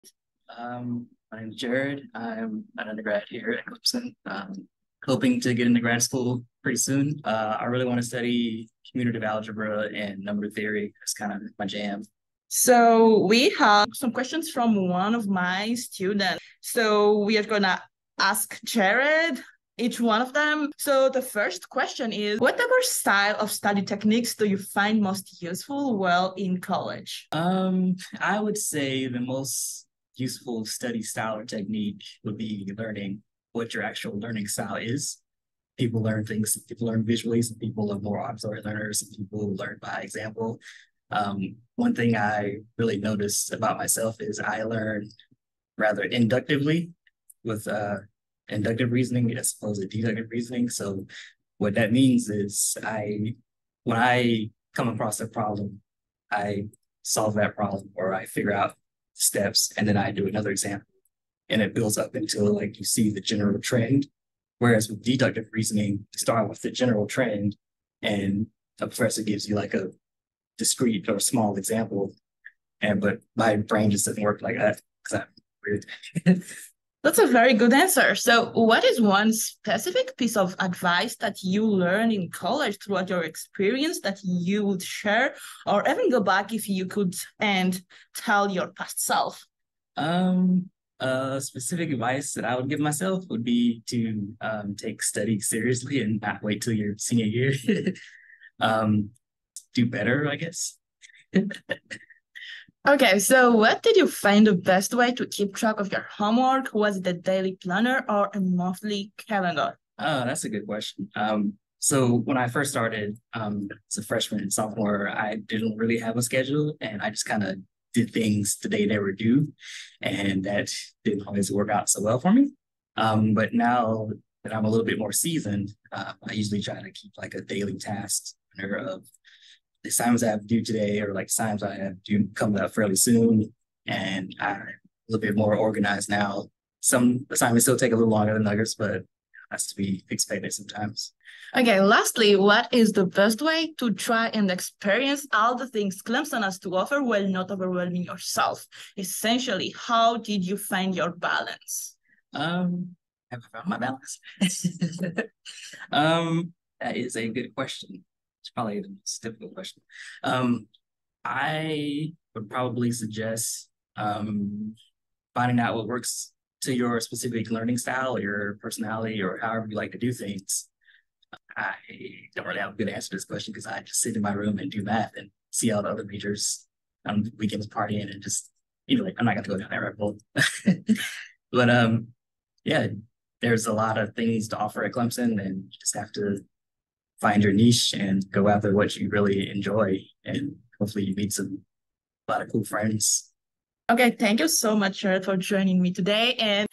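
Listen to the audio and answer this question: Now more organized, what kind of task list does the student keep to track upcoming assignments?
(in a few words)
Daily task.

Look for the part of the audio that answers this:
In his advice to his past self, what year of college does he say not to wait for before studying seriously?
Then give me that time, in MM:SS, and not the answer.
01:36.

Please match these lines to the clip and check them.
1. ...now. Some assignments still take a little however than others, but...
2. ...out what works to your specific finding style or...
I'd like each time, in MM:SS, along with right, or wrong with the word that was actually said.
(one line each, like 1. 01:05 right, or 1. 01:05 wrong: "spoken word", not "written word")
1. 02:16 wrong: "longer", not "however"
2. 02:45 wrong: "learning", not "finding".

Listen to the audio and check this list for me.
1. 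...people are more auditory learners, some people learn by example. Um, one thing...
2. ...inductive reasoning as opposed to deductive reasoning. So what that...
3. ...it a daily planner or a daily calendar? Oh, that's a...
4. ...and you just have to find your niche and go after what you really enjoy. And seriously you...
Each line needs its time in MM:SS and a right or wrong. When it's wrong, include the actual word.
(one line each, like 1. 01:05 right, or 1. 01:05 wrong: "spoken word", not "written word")
1. 00:37 right
2. 00:48 right
3. 01:46 wrong: "monthly", not "daily"
4. 03:05 wrong: "hopefully", not "seriously".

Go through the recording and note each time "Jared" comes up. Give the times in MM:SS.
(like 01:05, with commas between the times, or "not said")
00:01, 00:18.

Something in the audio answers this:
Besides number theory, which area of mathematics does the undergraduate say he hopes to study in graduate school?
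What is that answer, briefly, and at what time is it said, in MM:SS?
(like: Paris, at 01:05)
Commutative algebra, at 00:08.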